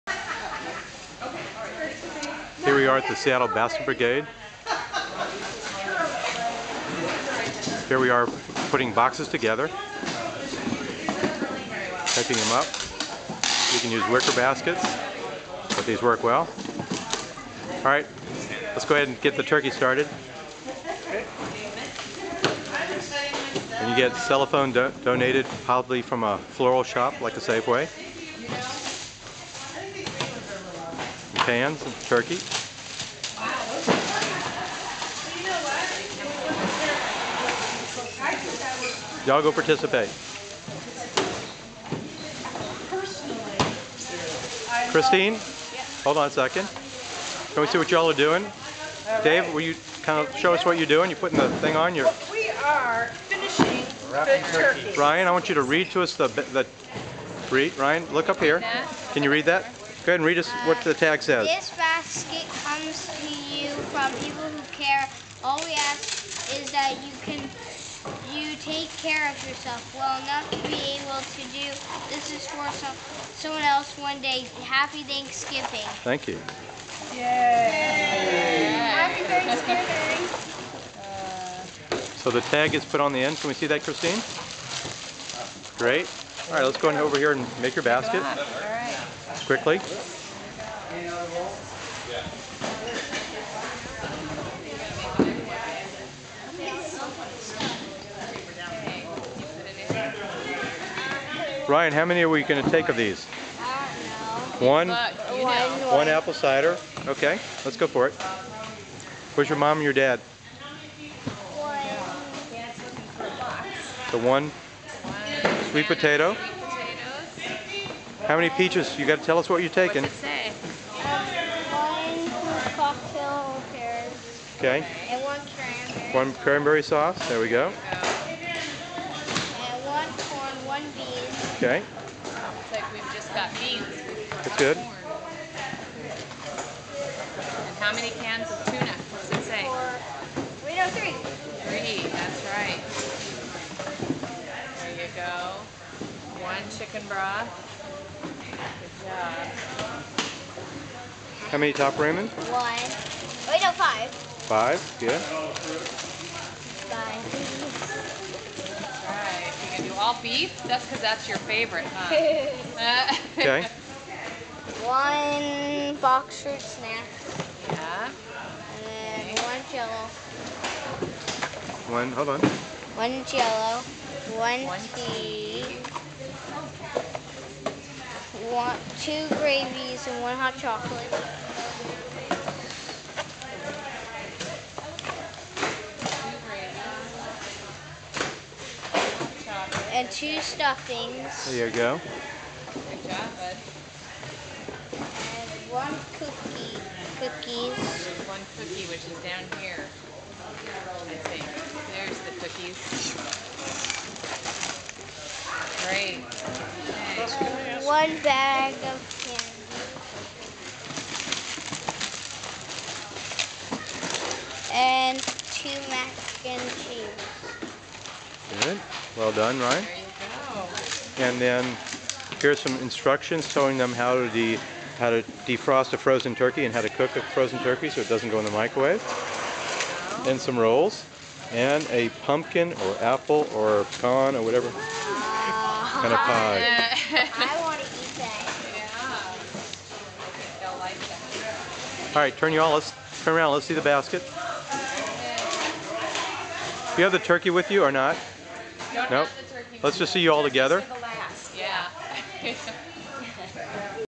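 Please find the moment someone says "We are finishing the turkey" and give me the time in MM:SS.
00:52.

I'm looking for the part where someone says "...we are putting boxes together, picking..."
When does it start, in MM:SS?
00:07.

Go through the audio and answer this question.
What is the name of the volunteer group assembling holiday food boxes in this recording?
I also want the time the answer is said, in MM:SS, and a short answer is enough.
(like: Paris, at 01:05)
Seattle Basket Brigade, at 00:03.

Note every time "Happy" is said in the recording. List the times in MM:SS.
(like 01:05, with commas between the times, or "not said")
01:14, 01:18.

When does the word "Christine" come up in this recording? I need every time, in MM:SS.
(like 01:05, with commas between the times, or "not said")
00:44, 01:23.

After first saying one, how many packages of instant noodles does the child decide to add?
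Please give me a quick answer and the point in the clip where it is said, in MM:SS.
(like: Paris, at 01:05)
5, at 02:32.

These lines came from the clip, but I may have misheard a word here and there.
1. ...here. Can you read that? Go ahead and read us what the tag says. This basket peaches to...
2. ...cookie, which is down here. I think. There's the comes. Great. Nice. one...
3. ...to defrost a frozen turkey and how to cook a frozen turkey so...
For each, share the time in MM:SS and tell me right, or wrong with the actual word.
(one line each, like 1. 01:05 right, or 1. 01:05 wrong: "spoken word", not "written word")
1. 00:58 wrong: "comes", not "peaches"
2. 03:18 wrong: "cookies", not "comes"
3. 03:45 right.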